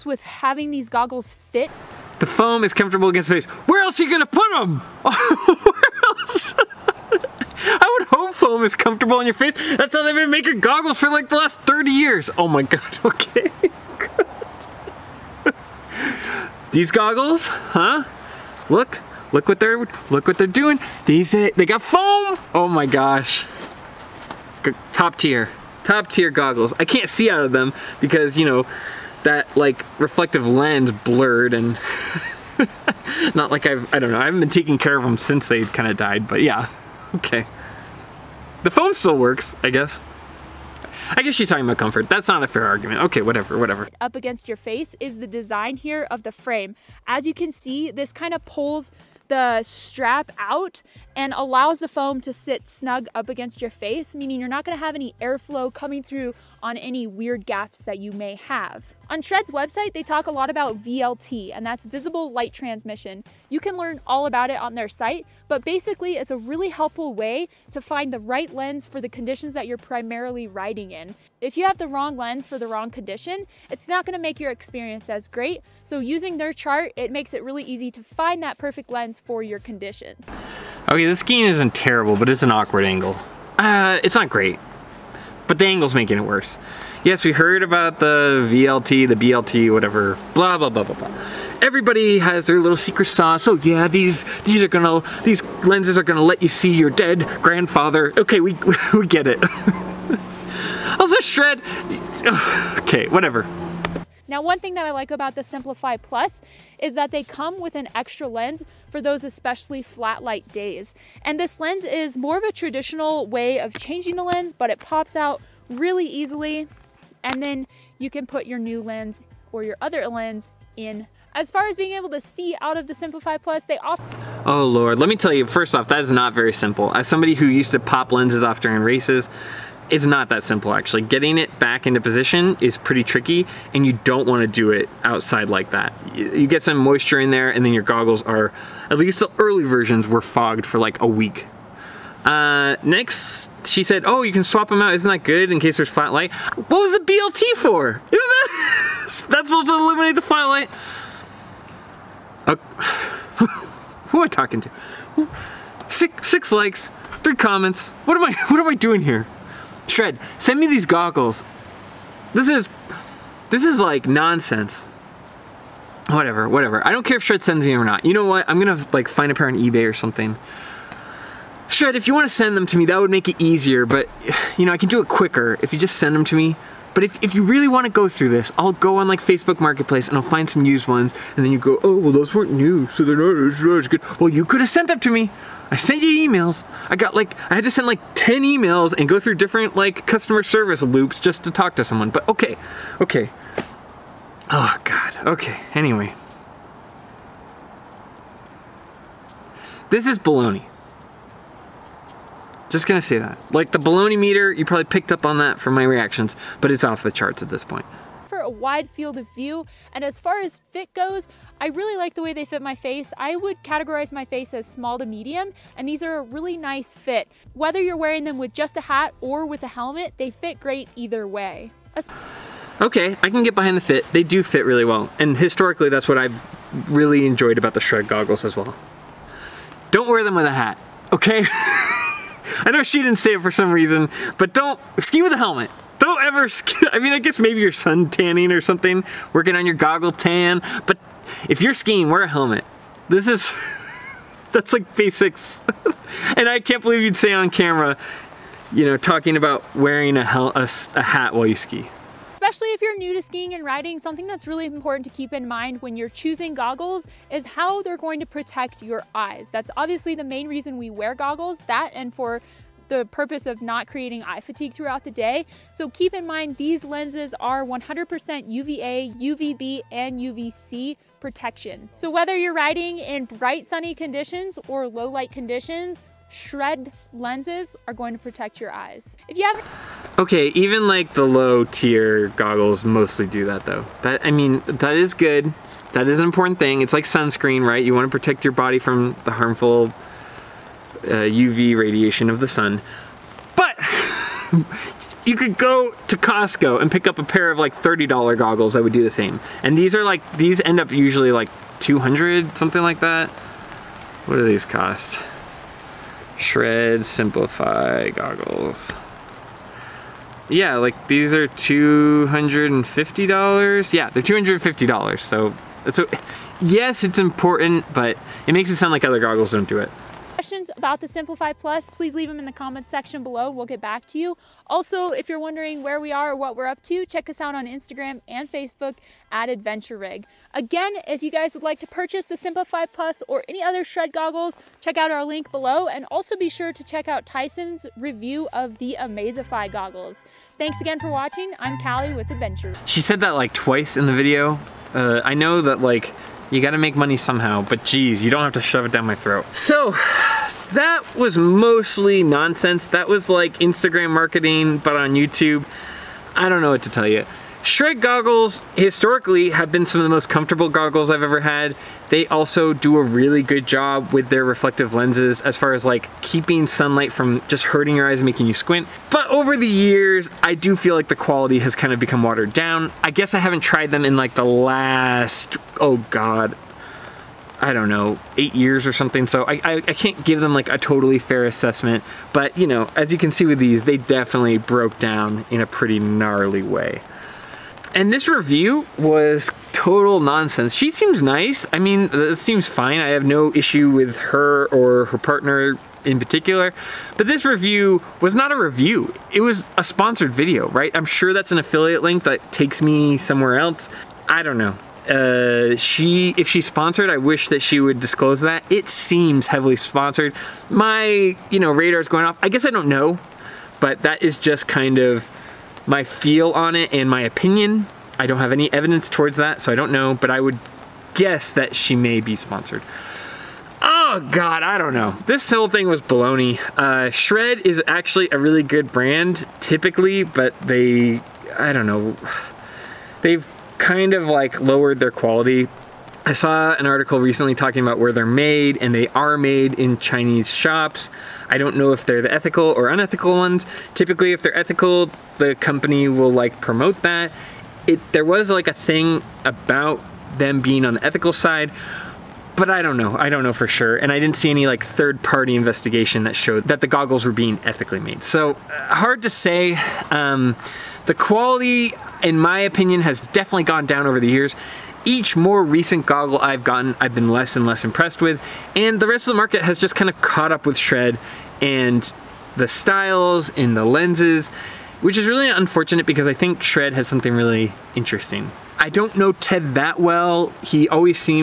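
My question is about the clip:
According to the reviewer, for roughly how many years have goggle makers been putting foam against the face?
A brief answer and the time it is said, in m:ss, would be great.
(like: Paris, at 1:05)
30 years, at 0:11.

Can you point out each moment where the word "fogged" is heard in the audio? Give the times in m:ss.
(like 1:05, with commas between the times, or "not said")
2:20.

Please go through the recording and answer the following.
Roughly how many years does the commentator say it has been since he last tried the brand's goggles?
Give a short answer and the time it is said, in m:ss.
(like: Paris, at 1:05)
8 years, at 6:18.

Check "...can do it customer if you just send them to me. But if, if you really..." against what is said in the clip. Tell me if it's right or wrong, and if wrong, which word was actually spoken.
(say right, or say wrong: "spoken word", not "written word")
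wrong: "quicker", not "customer".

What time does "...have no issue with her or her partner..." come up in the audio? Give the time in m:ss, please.
6:33.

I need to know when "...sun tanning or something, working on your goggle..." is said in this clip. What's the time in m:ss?
3:57.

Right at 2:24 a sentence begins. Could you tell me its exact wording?
Isn't that good in case there's flat light?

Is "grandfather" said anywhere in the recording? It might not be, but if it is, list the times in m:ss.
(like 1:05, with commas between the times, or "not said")
1:37.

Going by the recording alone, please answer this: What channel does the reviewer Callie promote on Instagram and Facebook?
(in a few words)
Adventure Rig.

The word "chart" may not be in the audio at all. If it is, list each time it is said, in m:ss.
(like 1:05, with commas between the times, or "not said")
1:16, 3:27.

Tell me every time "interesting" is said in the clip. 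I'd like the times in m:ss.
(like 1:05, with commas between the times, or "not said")
7:57.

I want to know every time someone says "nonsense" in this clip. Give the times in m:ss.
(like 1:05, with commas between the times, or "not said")
2:44, 5:52, 6:30.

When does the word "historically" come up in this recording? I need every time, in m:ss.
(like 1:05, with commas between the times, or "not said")
3:45, 5:58.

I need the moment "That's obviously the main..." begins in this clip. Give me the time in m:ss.
4:19.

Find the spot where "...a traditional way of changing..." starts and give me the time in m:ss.
1:52.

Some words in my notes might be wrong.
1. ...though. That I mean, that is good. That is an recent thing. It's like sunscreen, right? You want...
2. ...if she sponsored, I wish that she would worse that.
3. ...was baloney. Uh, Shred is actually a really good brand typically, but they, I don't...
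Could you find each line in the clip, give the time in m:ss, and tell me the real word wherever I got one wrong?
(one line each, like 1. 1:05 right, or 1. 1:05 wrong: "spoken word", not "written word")
1. 4:43 wrong: "important", not "recent"
2. 6:46 wrong: "disclose", not "worse"
3. 7:05 right.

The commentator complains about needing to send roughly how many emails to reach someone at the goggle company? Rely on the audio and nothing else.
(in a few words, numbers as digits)
10.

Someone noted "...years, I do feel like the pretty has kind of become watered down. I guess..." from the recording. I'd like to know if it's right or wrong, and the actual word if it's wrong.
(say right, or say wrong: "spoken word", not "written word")
wrong: "quality", not "pretty".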